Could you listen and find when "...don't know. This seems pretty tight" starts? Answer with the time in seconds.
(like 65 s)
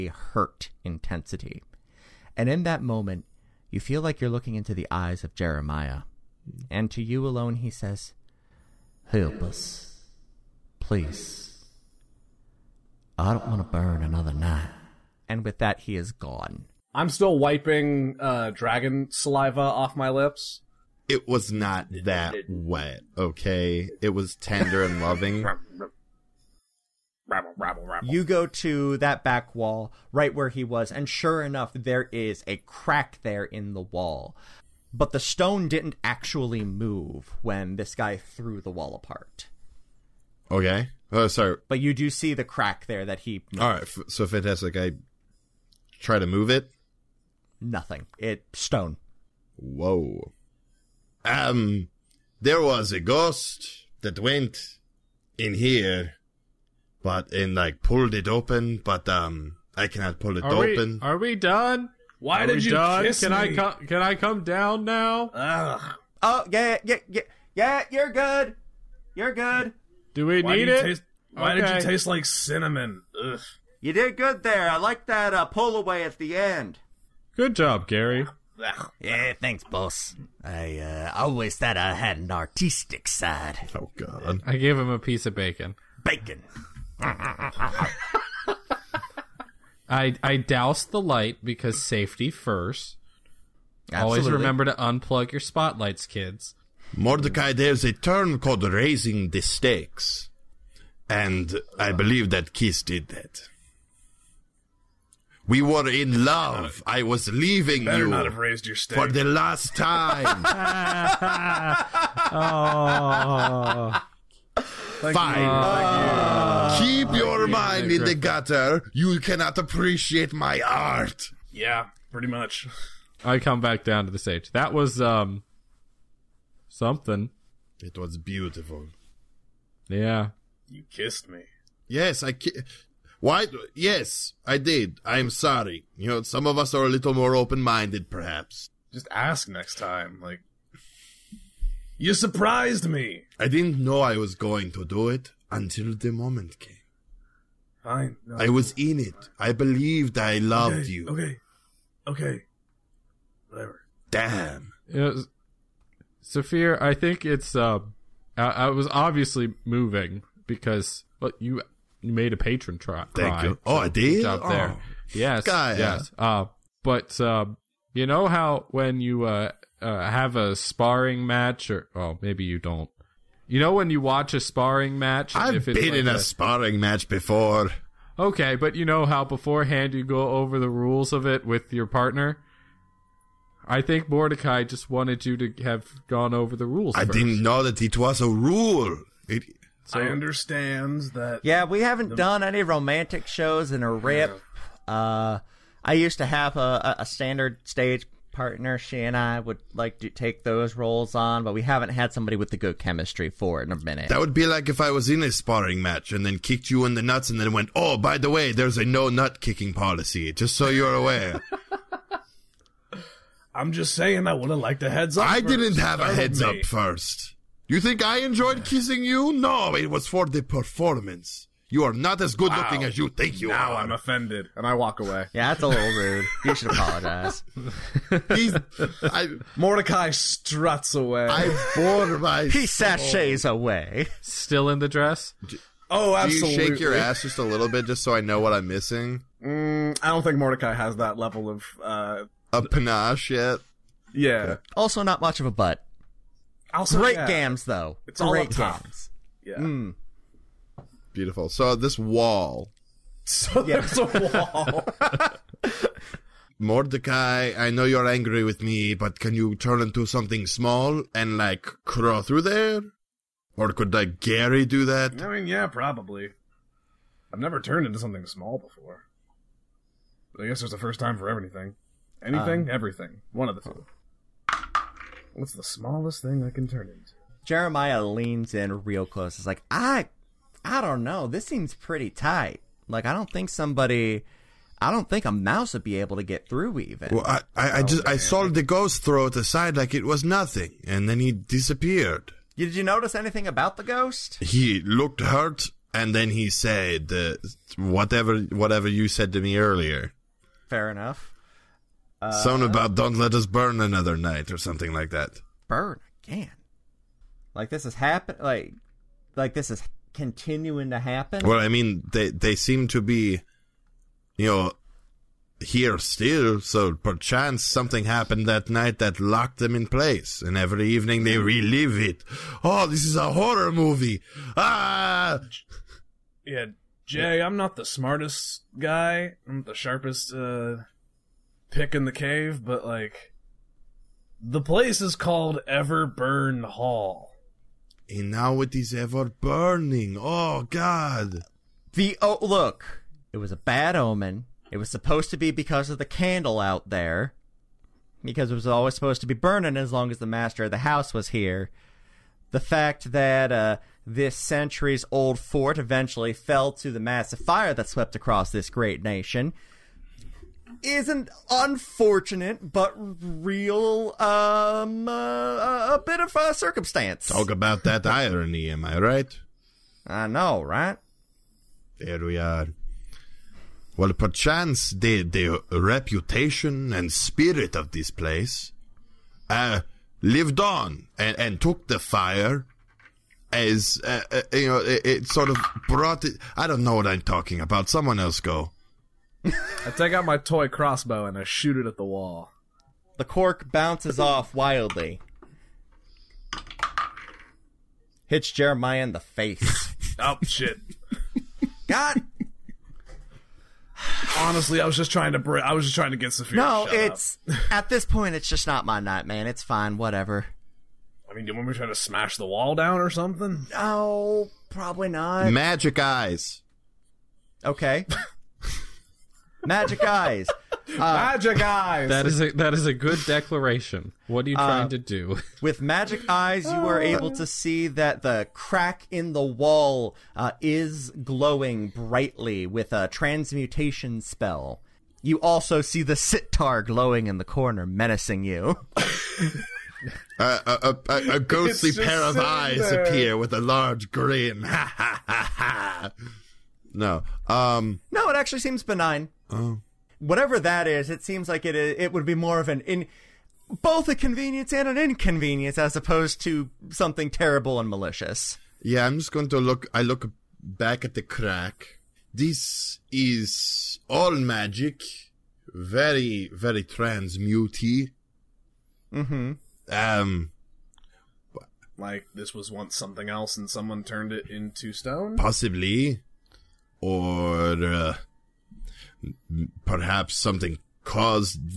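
280 s.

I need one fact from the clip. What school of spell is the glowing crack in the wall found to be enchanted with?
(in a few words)
transmutation.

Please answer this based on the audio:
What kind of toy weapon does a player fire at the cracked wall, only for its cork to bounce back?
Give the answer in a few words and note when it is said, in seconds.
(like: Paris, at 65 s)
crossbow, at 390 s.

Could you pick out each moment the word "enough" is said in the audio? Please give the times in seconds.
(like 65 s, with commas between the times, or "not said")
31 s, 300 s.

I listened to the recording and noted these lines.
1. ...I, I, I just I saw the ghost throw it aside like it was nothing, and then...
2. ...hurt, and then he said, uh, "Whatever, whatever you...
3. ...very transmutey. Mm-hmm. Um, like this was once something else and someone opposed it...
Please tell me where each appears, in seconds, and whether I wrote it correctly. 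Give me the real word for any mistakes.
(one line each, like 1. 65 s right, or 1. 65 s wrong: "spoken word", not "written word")
1. 287 s right
2. 295 s right
3. 466 s wrong: "turned", not "opposed".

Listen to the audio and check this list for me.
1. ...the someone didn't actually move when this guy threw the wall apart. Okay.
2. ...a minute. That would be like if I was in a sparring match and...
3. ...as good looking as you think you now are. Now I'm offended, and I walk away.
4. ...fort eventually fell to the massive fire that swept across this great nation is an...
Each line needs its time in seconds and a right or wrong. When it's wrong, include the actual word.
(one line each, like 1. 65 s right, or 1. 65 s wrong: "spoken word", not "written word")
1. 35 s wrong: "stone", not "someone"
2. 203 s right
3. 222 s right
4. 355 s right.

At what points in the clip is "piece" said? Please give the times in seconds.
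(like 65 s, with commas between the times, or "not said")
84 s.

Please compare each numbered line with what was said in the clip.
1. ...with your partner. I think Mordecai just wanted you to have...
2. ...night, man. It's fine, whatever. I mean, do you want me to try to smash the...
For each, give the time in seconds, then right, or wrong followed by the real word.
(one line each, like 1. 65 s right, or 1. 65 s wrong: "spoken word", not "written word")
1. 181 s right
2. 409 s right.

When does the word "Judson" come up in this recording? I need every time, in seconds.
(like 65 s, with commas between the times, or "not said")
not said.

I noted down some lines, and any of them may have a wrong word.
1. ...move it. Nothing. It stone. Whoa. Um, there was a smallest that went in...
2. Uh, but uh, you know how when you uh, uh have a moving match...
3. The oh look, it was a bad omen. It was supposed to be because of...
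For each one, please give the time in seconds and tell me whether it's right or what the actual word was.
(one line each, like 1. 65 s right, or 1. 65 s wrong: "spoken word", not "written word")
1. 46 s wrong: "ghost", not "smallest"
2. 166 s wrong: "sparring", not "moving"
3. 341 s right.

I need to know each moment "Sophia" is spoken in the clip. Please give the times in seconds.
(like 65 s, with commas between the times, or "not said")
156 s, 406 s.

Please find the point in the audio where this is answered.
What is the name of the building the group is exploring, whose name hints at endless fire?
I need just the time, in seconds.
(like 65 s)
335 s.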